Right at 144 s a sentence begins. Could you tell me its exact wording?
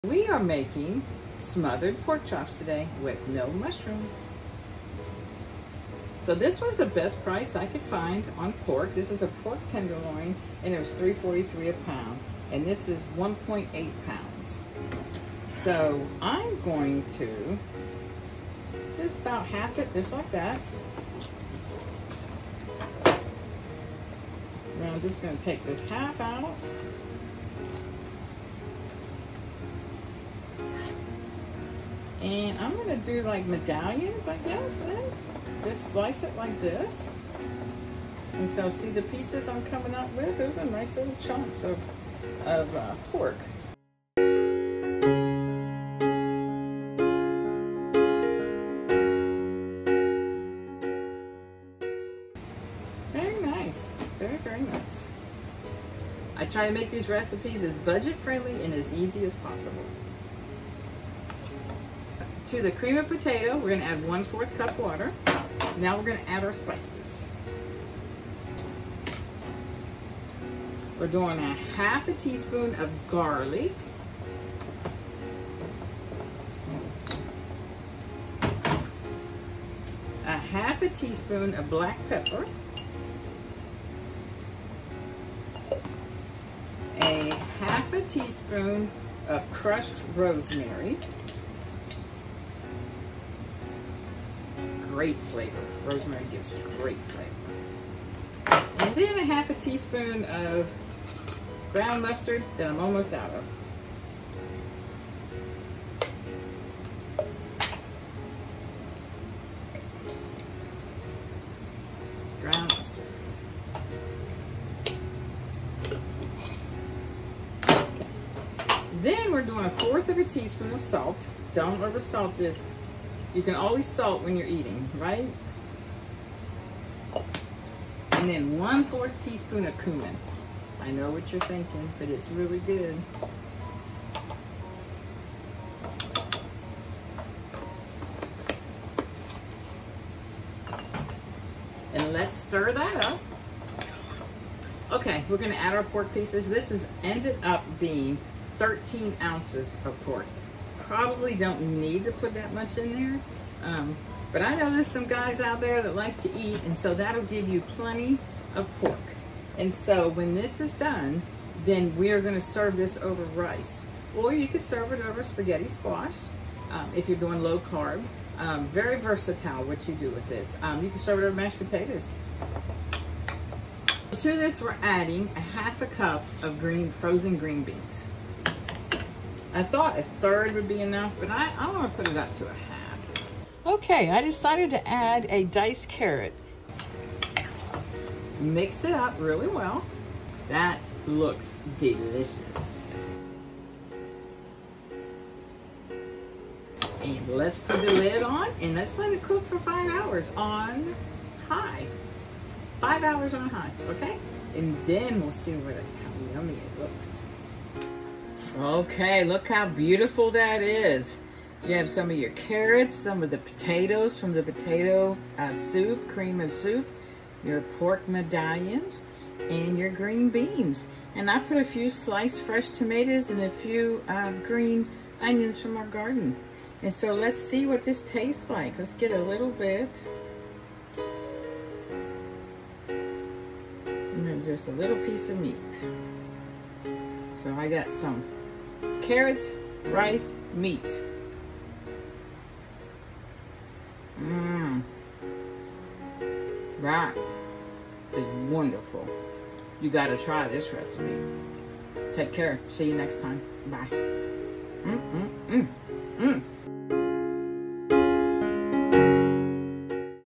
Okay, we're gonna add our pork pieces.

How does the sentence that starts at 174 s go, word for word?
To this, we're adding a half a cup of green frozen green beans.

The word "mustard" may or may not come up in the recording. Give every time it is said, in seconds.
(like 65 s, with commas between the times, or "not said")
102 s, 112 s.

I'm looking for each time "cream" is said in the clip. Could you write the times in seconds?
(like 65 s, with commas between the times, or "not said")
62 s, 216 s.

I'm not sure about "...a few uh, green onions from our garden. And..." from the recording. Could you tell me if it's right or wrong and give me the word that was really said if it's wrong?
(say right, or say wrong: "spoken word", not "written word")
right.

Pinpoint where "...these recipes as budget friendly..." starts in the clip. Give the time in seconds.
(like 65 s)
56 s.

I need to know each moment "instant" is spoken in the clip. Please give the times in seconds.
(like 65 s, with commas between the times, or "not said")
not said.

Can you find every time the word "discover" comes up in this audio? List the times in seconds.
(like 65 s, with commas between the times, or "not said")
not said.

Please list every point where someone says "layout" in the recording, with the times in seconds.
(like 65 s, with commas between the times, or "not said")
not said.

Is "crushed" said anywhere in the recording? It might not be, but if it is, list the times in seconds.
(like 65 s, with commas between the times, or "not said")
89 s.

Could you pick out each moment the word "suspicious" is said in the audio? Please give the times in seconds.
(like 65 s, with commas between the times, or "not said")
not said.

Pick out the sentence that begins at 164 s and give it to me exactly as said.
Or you could serve it over spaghetti squash um, if you're doing low carb.